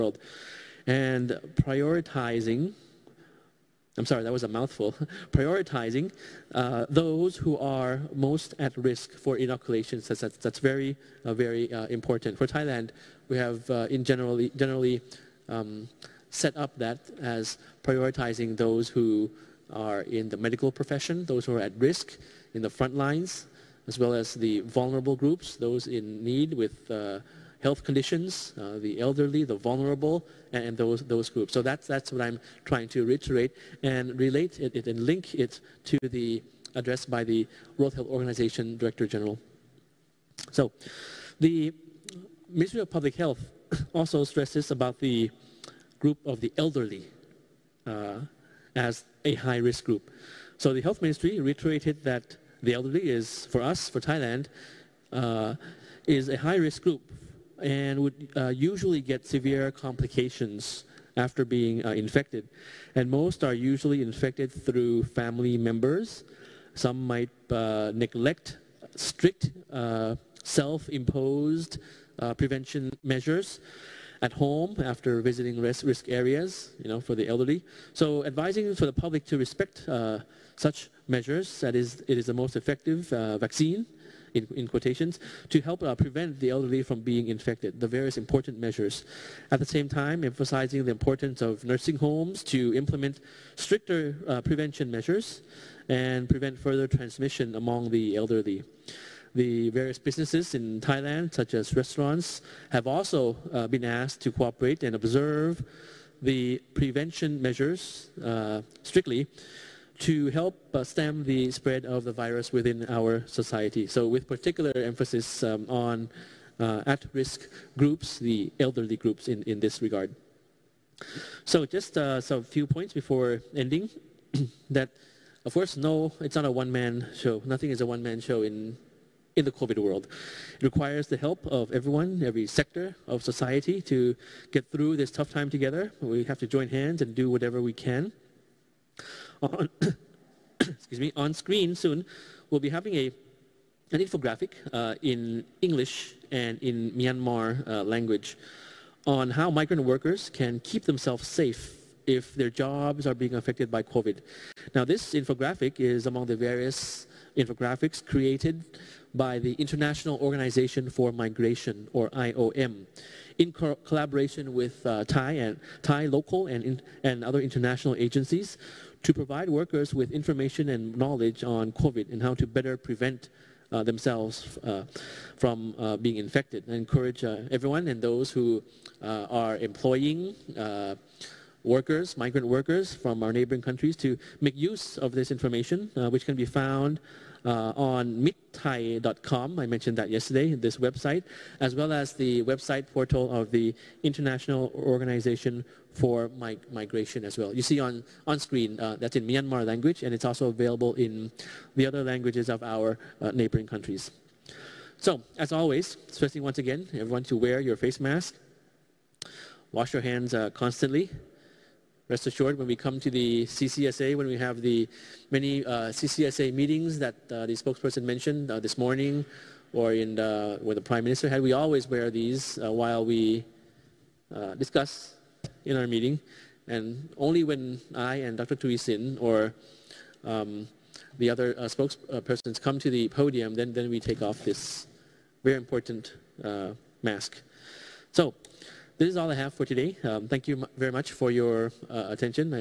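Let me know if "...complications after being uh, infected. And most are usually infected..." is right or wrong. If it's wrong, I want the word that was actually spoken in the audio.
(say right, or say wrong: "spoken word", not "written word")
right.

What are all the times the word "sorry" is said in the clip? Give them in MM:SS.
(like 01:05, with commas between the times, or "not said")
00:04.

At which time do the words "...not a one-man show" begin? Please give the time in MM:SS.
02:06.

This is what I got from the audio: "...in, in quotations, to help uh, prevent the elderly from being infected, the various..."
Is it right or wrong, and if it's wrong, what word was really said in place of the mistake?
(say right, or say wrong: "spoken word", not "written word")
right.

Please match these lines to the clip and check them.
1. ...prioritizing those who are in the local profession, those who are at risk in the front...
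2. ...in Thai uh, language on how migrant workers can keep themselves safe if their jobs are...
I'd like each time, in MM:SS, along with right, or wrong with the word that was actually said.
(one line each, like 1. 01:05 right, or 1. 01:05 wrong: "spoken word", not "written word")
1. 00:17 wrong: "medical", not "local"
2. 02:26 wrong: "Myanmar", not "Thai".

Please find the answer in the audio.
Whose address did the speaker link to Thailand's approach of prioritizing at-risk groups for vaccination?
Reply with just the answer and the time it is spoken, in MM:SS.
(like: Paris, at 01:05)
World Health Organization Director General, at 00:37.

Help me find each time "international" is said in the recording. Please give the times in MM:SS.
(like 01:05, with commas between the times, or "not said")
02:39, 02:47, 03:14.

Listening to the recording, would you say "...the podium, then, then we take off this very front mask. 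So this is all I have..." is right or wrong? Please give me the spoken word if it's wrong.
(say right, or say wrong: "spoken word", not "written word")
wrong: "important", not "front".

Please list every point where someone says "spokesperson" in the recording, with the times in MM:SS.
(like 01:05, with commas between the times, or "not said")
03:37, 03:51.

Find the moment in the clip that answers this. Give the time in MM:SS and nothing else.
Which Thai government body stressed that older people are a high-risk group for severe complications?
00:42.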